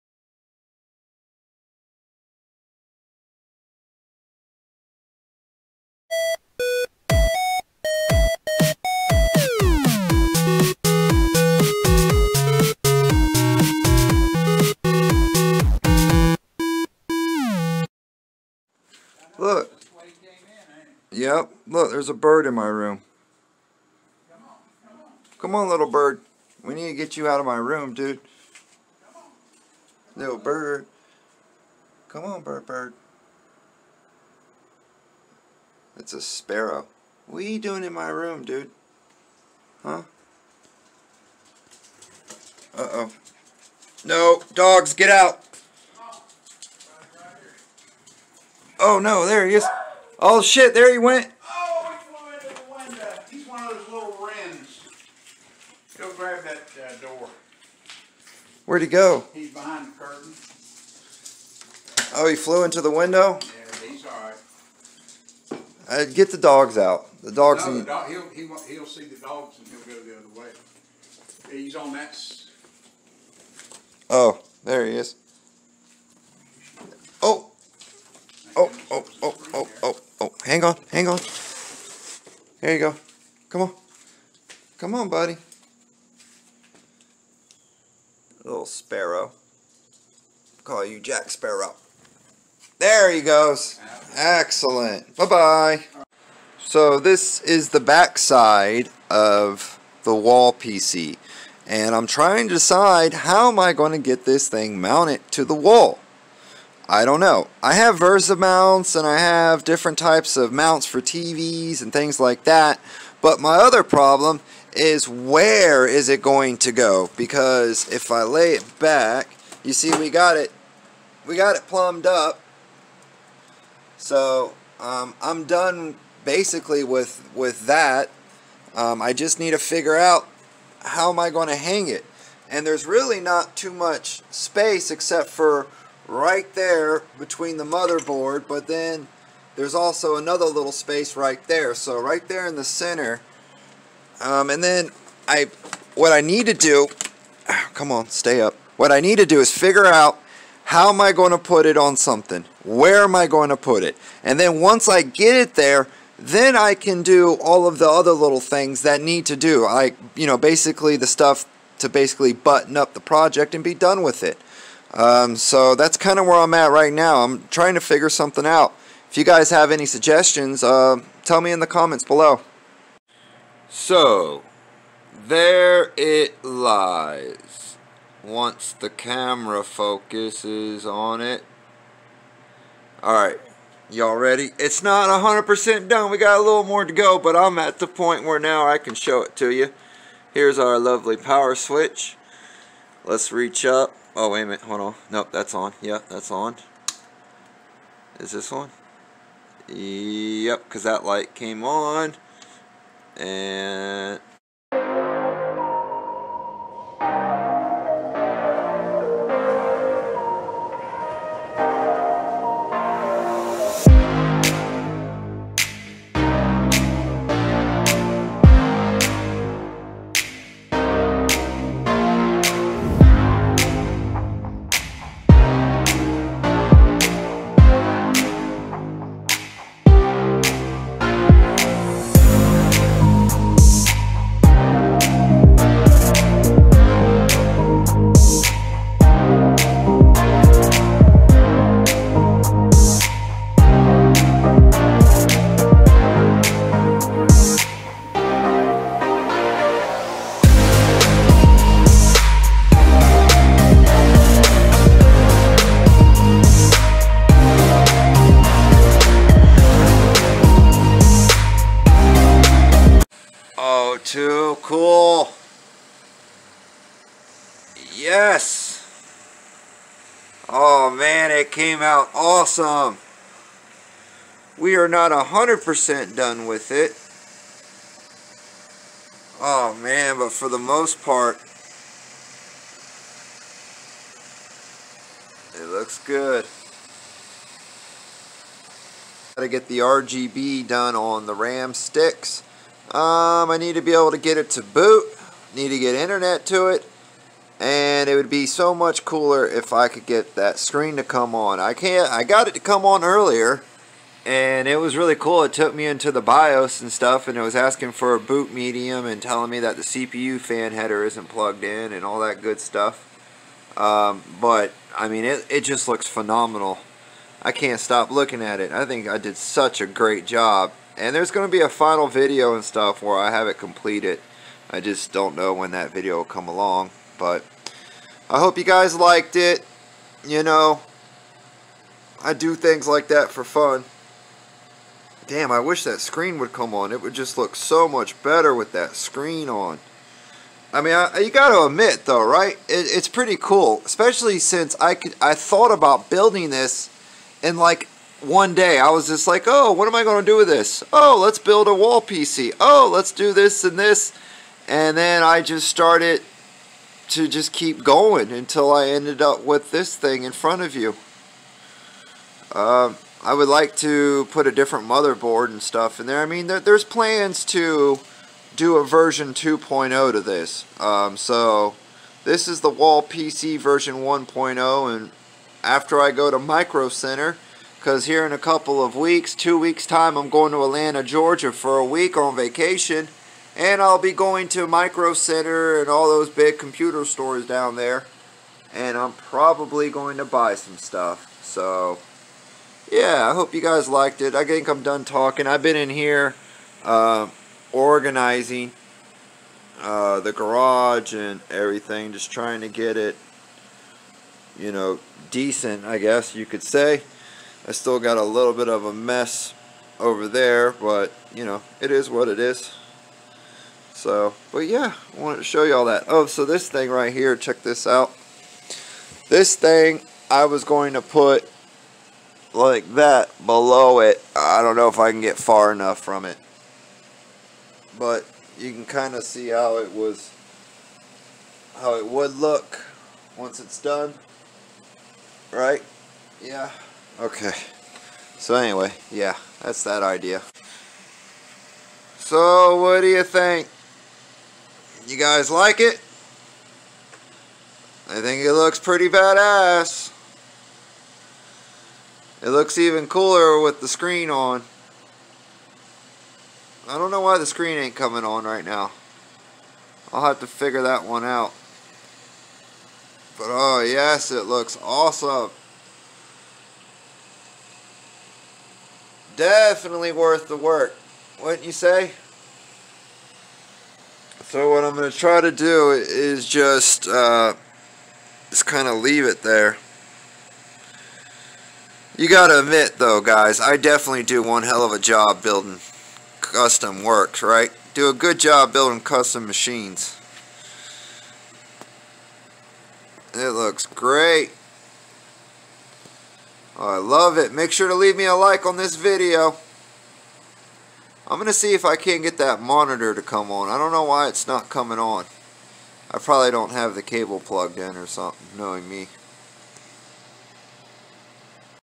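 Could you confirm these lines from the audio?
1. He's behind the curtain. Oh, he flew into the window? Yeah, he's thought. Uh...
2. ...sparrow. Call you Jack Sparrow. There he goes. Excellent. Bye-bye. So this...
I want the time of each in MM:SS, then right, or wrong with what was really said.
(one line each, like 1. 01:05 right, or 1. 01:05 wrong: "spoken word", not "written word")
1. 00:59 wrong: "alright", not "thought"
2. 01:28 right.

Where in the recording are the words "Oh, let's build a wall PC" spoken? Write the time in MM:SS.
05:50.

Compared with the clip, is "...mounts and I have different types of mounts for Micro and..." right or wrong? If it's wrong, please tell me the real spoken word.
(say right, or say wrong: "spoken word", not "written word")
wrong: "TVs", not "Micro".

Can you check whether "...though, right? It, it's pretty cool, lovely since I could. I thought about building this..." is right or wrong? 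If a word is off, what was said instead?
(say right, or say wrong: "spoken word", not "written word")
wrong: "especially", not "lovely".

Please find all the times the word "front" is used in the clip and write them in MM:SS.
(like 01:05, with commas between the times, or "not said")
06:00.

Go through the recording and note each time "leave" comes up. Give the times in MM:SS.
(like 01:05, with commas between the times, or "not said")
07:58, 08:17.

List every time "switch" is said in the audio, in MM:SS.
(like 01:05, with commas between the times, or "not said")
03:11.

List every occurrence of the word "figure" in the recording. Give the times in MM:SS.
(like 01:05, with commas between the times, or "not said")
02:09, 02:29, 02:47, 07:40.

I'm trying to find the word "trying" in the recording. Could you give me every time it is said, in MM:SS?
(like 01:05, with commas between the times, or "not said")
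01:42, 02:47, 06:42.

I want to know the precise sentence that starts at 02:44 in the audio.
Um, so that's kind of where I'm at right now.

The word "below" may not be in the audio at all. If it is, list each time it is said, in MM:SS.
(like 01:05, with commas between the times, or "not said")
02:52, 07:03.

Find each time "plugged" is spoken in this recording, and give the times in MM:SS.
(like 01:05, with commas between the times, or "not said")
05:11, 08:27.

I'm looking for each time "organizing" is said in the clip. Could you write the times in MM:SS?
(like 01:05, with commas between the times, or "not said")
06:37.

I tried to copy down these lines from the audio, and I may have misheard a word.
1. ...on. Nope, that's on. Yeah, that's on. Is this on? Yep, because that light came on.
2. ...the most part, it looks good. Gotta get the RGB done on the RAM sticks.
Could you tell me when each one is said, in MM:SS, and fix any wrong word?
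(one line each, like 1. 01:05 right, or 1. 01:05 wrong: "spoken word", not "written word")
1. 03:14 right
2. 04:40 right.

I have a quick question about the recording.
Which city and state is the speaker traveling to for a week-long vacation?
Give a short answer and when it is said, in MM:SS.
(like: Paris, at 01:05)
Atlanta, Georgia, at 06:20.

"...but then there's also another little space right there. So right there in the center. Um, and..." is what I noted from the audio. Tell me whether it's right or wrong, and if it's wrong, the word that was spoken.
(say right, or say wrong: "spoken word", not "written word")
right.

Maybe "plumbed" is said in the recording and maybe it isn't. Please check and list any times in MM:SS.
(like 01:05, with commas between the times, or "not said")
02:01.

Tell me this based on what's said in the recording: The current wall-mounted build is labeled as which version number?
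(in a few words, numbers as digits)
1.0.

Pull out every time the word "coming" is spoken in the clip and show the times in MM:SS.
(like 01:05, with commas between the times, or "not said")
07:37, 08:24.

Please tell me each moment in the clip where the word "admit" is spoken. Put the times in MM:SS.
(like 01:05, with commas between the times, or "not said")
05:41, 08:02.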